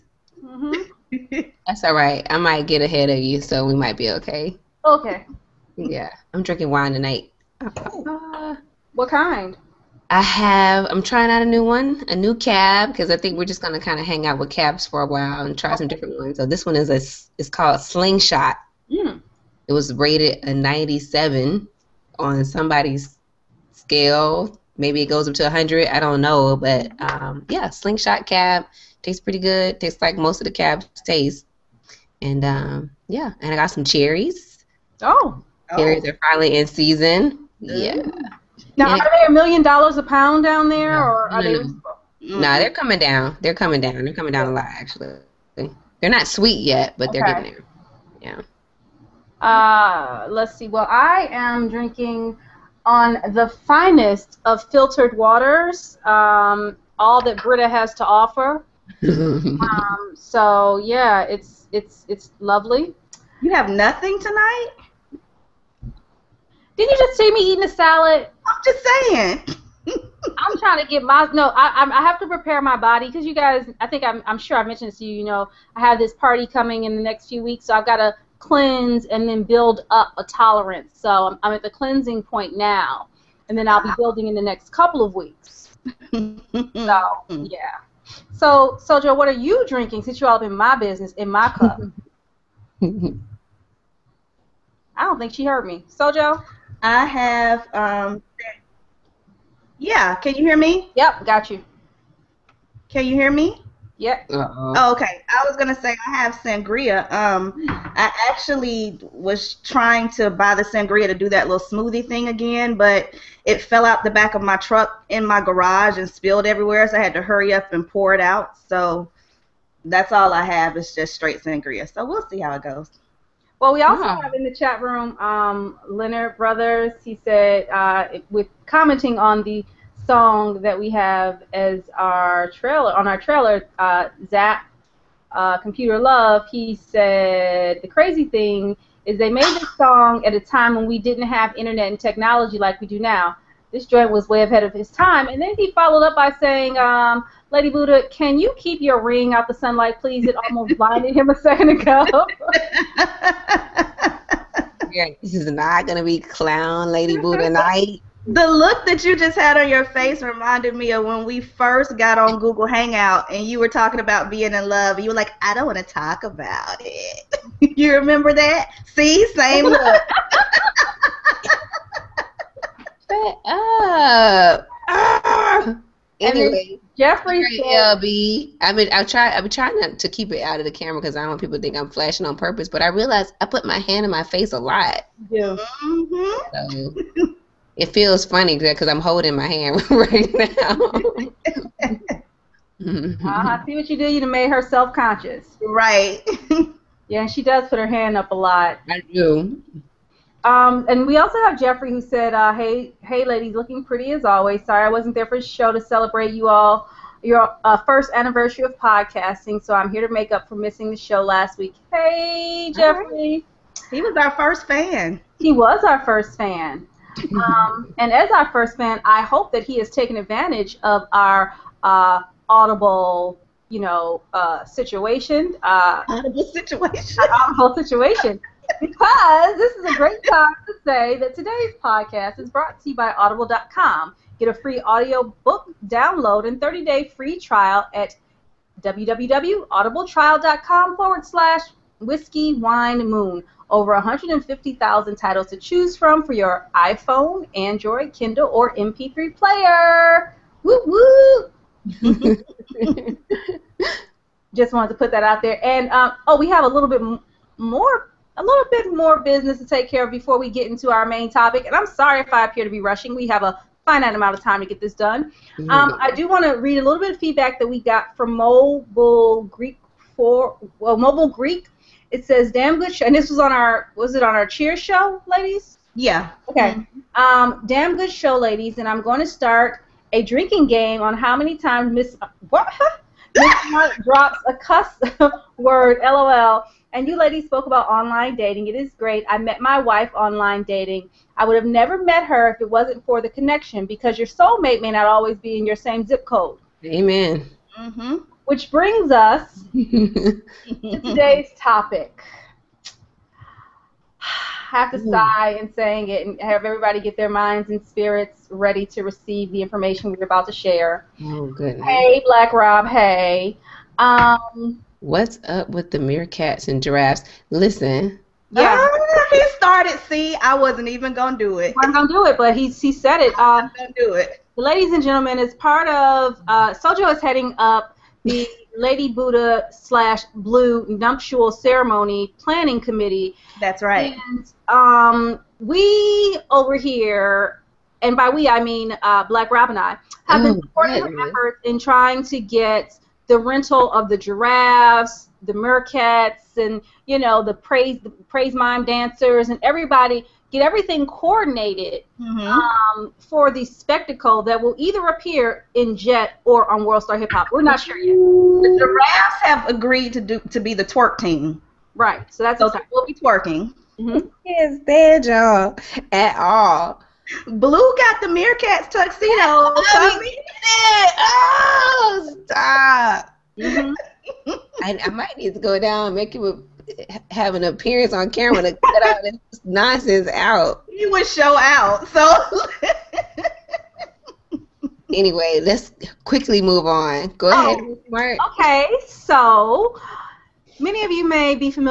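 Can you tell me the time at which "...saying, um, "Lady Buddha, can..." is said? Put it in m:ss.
2:26.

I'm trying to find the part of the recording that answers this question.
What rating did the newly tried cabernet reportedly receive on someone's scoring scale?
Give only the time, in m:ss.
0:20.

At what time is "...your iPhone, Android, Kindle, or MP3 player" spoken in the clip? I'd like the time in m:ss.
4:06.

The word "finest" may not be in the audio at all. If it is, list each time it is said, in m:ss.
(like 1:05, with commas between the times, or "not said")
0:53.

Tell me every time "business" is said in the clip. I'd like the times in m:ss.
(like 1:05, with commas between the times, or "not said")
1:30, 4:19.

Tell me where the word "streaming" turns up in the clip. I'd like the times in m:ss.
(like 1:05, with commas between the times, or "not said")
not said.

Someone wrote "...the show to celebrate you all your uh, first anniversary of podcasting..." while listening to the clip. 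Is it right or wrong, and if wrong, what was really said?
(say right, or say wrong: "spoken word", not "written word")
right.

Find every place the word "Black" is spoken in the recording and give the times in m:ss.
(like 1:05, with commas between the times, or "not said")
5:12, 5:39.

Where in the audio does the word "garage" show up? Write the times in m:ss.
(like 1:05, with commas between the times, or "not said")
1:55.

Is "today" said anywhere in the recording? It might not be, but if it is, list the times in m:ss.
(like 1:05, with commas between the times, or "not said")
3:51, 5:00.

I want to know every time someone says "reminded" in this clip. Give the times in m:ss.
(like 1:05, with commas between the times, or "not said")
2:40.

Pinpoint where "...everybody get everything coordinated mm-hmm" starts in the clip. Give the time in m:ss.
5:49.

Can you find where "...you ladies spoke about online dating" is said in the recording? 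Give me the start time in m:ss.
4:47.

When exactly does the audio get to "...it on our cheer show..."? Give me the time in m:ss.
4:34.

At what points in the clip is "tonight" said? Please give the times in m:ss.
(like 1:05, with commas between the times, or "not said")
0:06, 1:04.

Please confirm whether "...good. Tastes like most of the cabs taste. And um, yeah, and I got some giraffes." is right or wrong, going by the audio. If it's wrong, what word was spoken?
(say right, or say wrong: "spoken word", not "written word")
wrong: "cherries", not "giraffes".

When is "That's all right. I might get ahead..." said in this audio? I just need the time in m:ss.
0:01.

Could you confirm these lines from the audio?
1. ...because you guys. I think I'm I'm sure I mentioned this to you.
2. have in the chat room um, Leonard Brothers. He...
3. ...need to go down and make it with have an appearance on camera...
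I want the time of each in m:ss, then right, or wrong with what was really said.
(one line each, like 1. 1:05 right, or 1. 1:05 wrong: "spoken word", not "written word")
1. 1:13 right
2. 2:04 right
3. 6:15 right.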